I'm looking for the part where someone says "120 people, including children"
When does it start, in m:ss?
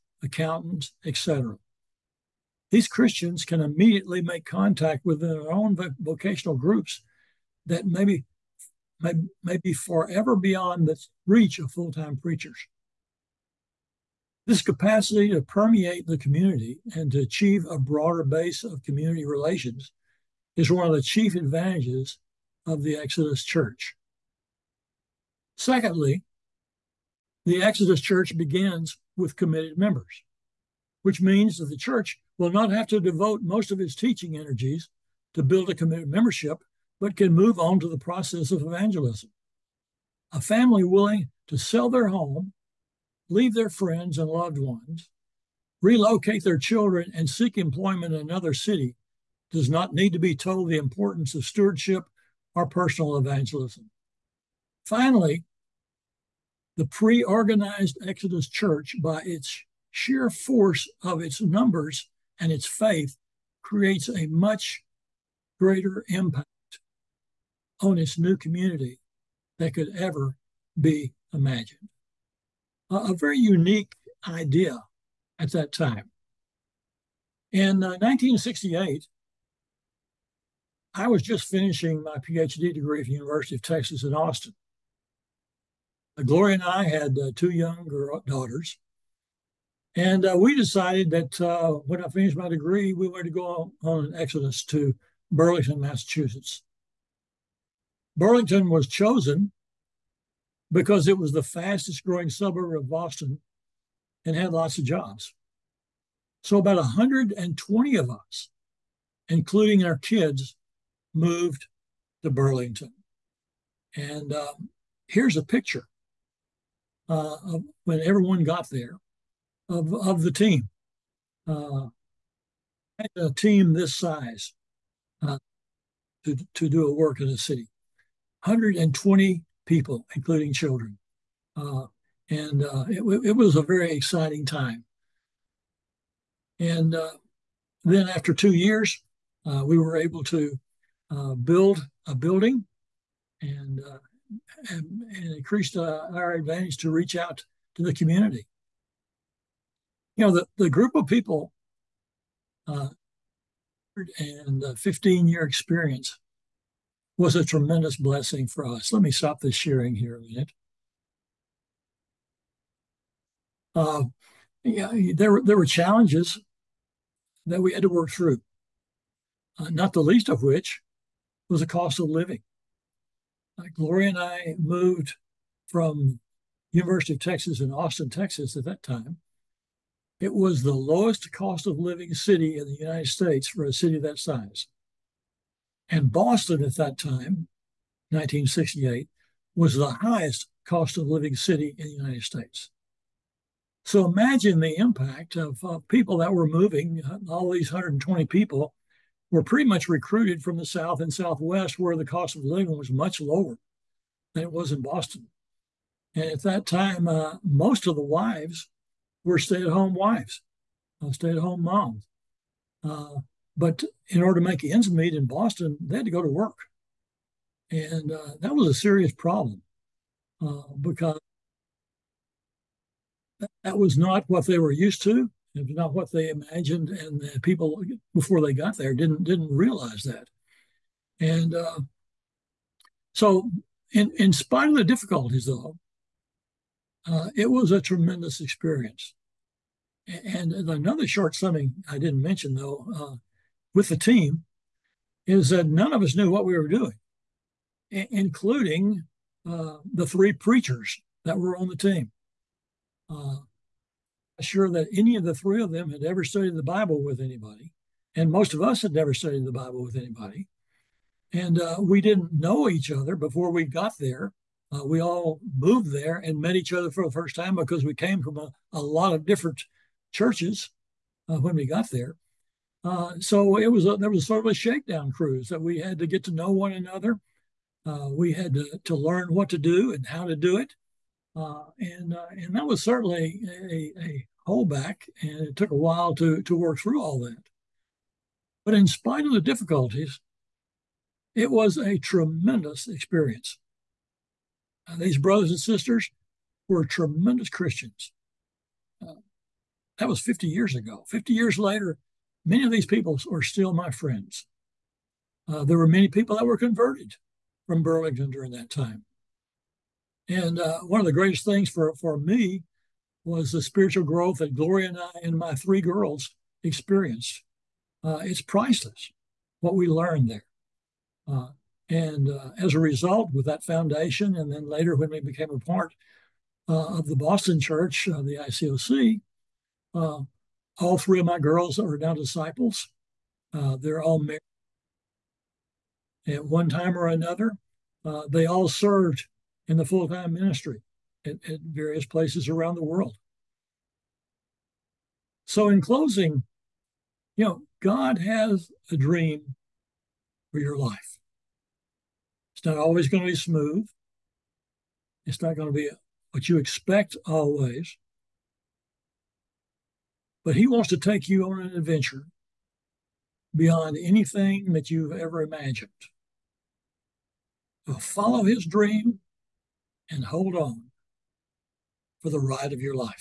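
2:08.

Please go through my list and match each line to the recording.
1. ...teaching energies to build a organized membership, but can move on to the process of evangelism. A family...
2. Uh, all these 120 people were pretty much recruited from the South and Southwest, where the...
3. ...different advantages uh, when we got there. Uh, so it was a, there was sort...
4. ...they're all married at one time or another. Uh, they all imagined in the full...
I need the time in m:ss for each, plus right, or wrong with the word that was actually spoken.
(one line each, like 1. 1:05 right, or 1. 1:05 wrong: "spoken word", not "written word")
1. 0:33 wrong: "committed", not "organized"
2. 3:17 right
3. 4:29 wrong: "churches", not "advantages"
4. 5:33 wrong: "served", not "imagined".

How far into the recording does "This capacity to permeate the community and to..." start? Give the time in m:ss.
0:14.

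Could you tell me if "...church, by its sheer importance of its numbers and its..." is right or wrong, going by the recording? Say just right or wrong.
wrong.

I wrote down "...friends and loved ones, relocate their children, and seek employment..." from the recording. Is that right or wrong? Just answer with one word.
right.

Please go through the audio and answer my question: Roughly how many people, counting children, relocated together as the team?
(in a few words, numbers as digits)
120.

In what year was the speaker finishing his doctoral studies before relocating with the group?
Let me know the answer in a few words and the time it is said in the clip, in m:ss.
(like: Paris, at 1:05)
1968, at 1:17.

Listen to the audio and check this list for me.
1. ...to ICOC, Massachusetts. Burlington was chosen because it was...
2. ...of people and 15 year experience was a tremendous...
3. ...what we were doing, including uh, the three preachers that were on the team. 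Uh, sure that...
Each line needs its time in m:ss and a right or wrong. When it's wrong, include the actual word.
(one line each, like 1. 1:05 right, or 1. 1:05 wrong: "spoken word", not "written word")
1. 1:34 wrong: "Burlington", not "ICOC"
2. 2:30 right
3. 4:06 right.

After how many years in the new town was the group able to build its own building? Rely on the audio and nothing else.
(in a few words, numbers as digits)
2.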